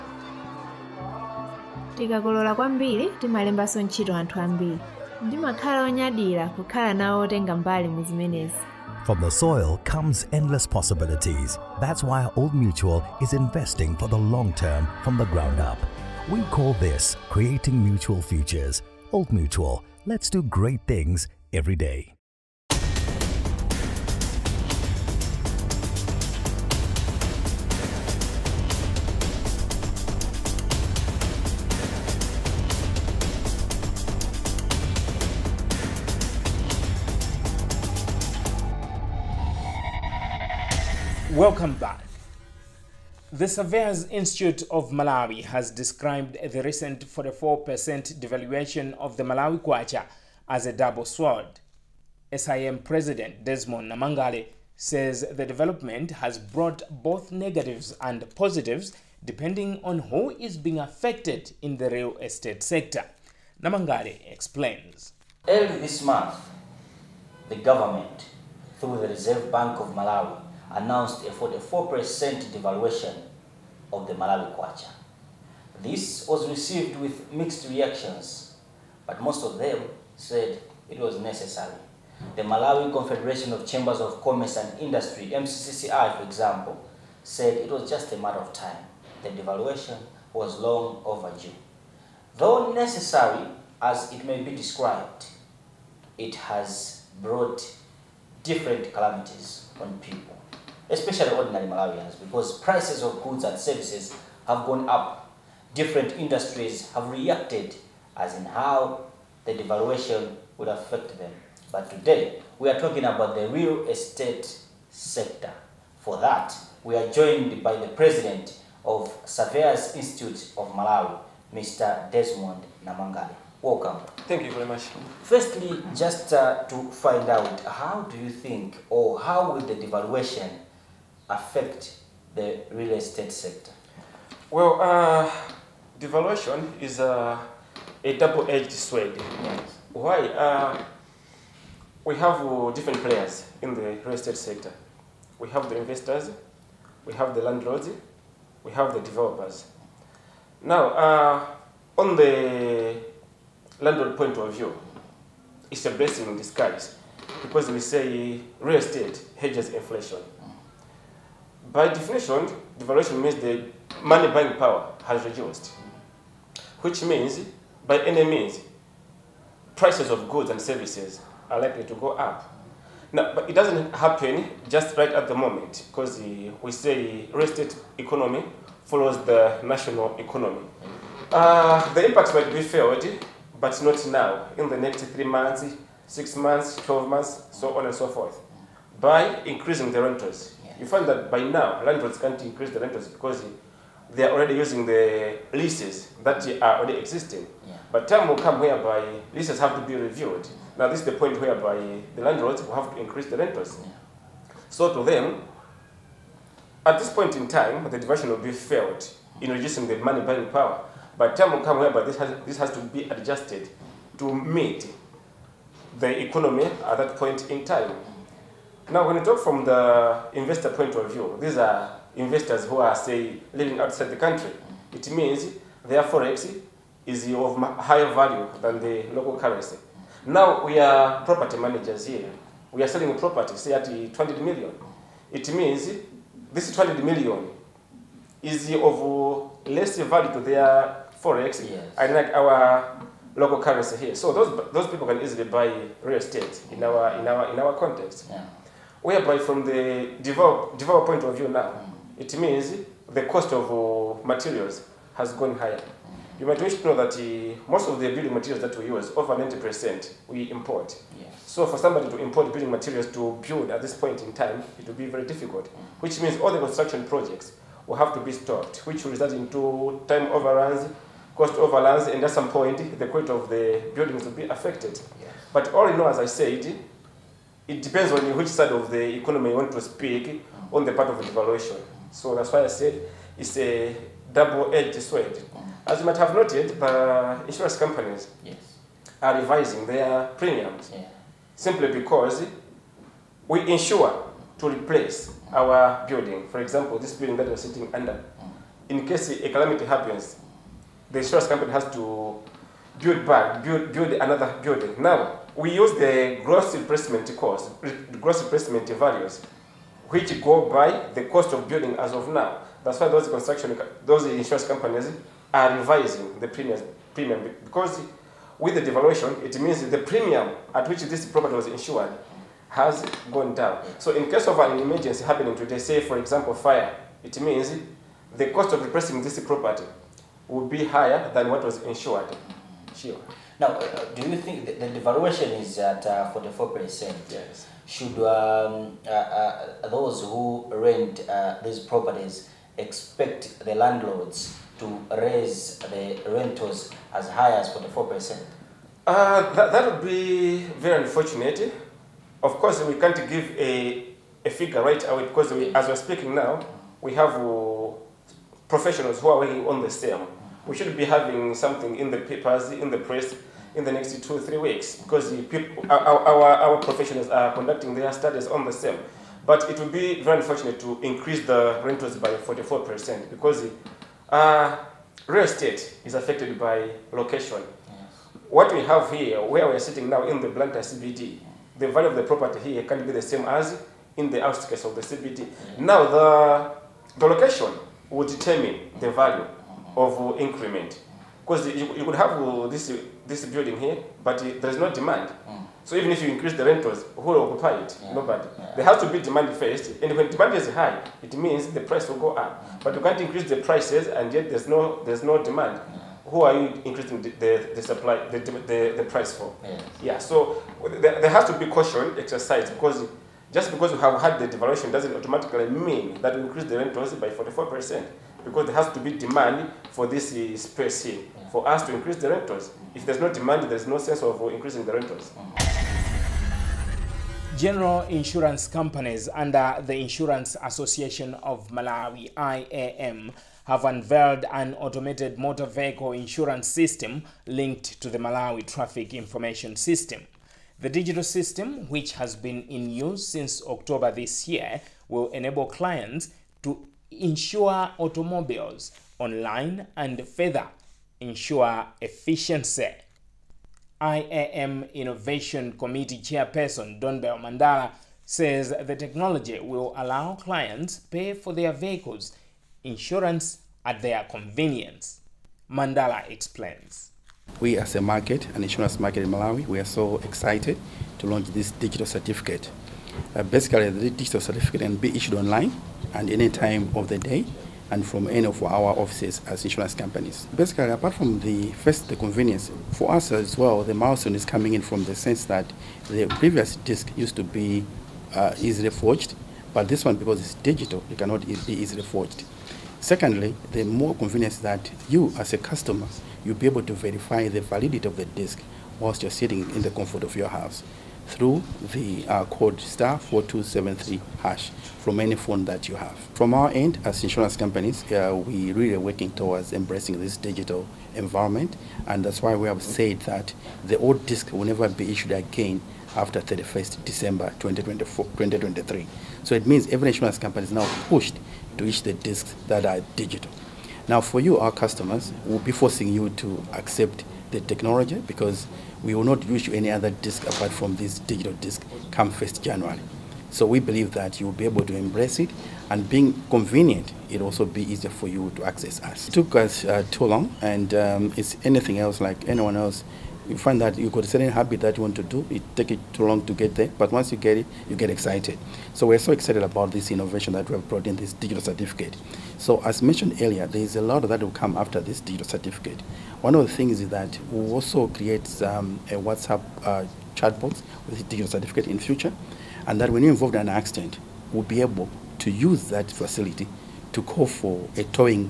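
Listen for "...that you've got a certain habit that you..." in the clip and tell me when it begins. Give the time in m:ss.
9:03.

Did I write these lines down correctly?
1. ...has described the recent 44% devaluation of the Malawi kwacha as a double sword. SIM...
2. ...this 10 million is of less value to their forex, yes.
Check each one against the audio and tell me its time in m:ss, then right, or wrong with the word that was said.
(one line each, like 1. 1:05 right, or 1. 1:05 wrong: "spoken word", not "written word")
1. 0:45 right
2. 3:56 wrong: "20", not "10".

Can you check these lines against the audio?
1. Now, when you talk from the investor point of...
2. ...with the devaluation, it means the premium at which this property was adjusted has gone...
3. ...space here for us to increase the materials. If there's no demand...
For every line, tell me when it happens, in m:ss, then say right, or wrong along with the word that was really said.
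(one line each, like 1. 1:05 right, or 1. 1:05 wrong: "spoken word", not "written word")
1. 3:38 right
2. 5:18 wrong: "insured", not "adjusted"
3. 7:00 wrong: "rentals", not "materials".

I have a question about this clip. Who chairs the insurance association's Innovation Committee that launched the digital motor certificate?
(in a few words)
Don Bell Mandala.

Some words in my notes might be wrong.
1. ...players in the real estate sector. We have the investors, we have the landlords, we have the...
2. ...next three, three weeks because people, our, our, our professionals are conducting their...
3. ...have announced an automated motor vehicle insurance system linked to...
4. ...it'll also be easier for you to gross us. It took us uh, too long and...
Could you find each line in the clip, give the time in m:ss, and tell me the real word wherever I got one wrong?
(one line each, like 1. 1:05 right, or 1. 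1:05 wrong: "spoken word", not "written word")
1. 2:23 right
2. 6:03 wrong: "two", not "three"
3. 7:13 wrong: "unveiled", not "announced"
4. 8:57 wrong: "access", not "gross".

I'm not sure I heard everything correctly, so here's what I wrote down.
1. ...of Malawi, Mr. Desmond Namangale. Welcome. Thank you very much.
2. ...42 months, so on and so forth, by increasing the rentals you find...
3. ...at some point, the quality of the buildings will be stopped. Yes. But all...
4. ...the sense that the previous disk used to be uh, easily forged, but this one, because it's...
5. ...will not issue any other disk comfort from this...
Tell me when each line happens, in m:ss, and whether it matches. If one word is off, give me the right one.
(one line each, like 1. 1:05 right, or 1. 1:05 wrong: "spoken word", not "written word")
1. 2:00 right
2. 3:06 wrong: "12", not "42"
3. 4:32 wrong: "affected", not "stopped"
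4. 8:05 right
5. 8:49 wrong: "apart", not "comfort".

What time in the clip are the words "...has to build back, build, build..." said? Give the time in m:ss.
5:01.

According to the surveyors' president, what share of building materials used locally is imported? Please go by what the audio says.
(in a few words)
over 90%.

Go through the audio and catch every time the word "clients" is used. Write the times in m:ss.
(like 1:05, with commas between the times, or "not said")
7:25, 7:40.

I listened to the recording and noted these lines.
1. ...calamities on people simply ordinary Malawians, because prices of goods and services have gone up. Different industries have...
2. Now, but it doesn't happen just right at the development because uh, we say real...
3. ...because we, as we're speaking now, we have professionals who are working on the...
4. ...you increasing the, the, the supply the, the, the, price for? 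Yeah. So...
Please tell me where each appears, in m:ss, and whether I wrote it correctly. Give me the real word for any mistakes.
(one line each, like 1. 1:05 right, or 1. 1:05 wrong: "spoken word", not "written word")
1. 1:38 wrong: "especially", not "simply"
2. 2:53 wrong: "moment", not "development"
3. 5:55 right
4. 6:46 right.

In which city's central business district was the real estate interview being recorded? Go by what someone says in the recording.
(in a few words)
Blantyre.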